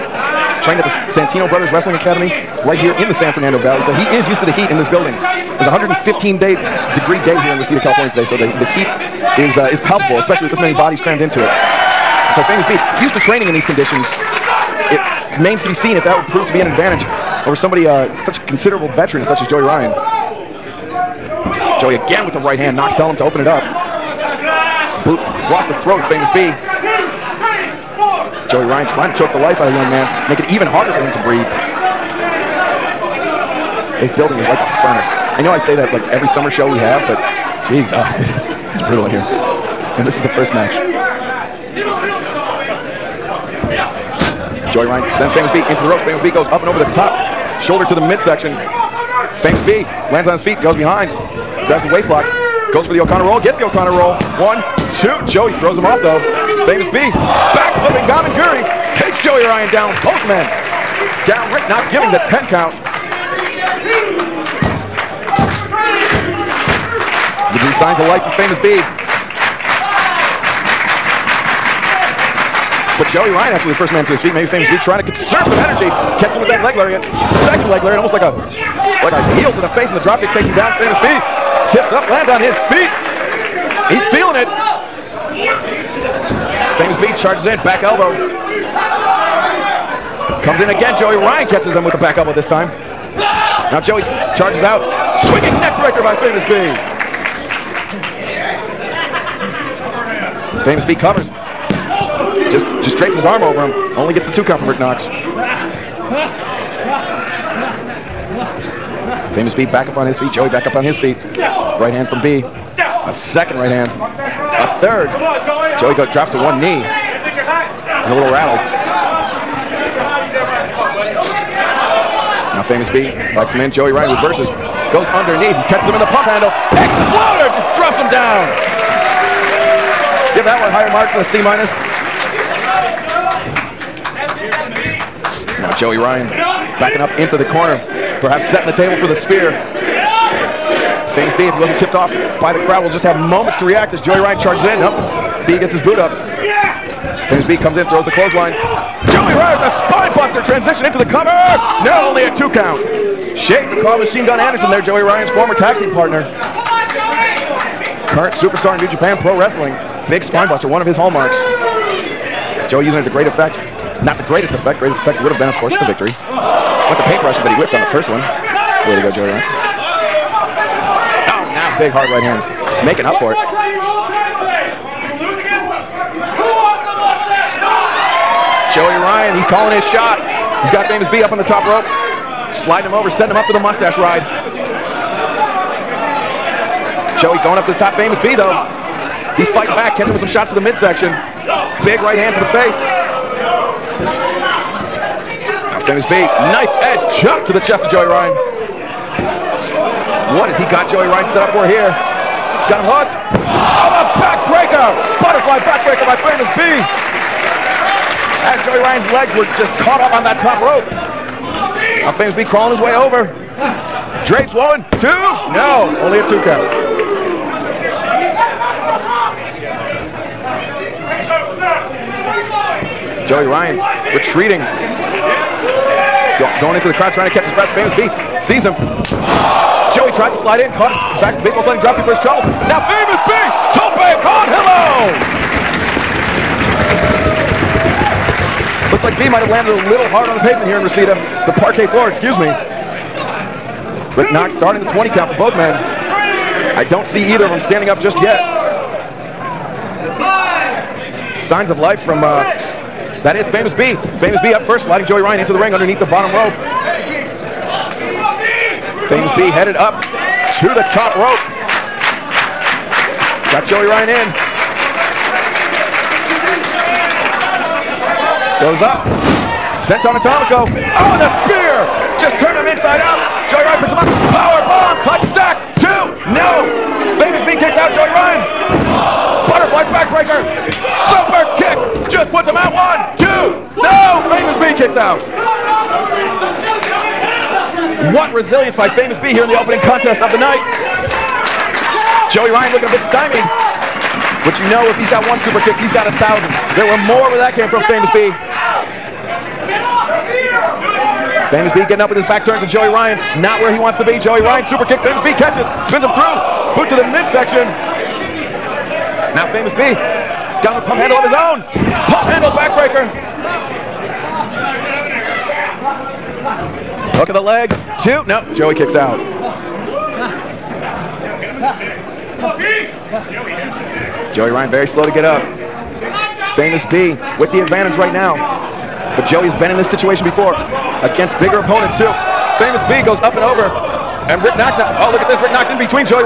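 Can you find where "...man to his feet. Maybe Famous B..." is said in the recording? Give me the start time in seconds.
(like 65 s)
73 s.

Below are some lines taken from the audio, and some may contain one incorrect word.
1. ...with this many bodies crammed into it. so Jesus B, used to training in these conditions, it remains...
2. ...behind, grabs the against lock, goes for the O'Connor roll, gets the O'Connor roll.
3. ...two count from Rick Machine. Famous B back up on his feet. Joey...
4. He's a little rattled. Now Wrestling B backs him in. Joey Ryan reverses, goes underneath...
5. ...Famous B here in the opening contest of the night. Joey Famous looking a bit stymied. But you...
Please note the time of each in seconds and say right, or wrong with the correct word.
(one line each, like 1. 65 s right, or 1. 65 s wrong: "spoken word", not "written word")
1. 10 s wrong: "Famous", not "Jesus"
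2. 50 s wrong: "waist", not "against"
3. 104 s wrong: "Knox", not "Machine"
4. 116 s wrong: "Famous", not "Wrestling"
5. 288 s wrong: "Ryan", not "Famous".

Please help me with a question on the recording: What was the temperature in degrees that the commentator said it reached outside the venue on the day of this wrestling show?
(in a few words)
115.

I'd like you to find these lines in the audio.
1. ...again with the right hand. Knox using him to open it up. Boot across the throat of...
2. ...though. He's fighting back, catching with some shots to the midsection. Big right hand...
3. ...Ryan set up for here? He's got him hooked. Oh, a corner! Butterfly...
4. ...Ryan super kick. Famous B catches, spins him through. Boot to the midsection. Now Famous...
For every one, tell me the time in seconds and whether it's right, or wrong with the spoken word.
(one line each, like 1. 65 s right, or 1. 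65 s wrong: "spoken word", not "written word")
1. 21 s wrong: "telling", not "using"
2. 188 s right
3. 201 s wrong: "backbreaker", not "corner"
4. 304 s right.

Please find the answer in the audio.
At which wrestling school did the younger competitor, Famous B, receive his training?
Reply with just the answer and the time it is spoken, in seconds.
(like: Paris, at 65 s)
Santino Brothers Wrestling Academy, at 1 s.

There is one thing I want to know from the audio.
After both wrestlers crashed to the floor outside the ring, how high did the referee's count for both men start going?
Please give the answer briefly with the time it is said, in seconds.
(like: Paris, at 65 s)
20, at 244 s.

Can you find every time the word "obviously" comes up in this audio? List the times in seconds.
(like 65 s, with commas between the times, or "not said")
not said.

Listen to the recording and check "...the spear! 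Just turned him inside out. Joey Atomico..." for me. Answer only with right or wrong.
wrong.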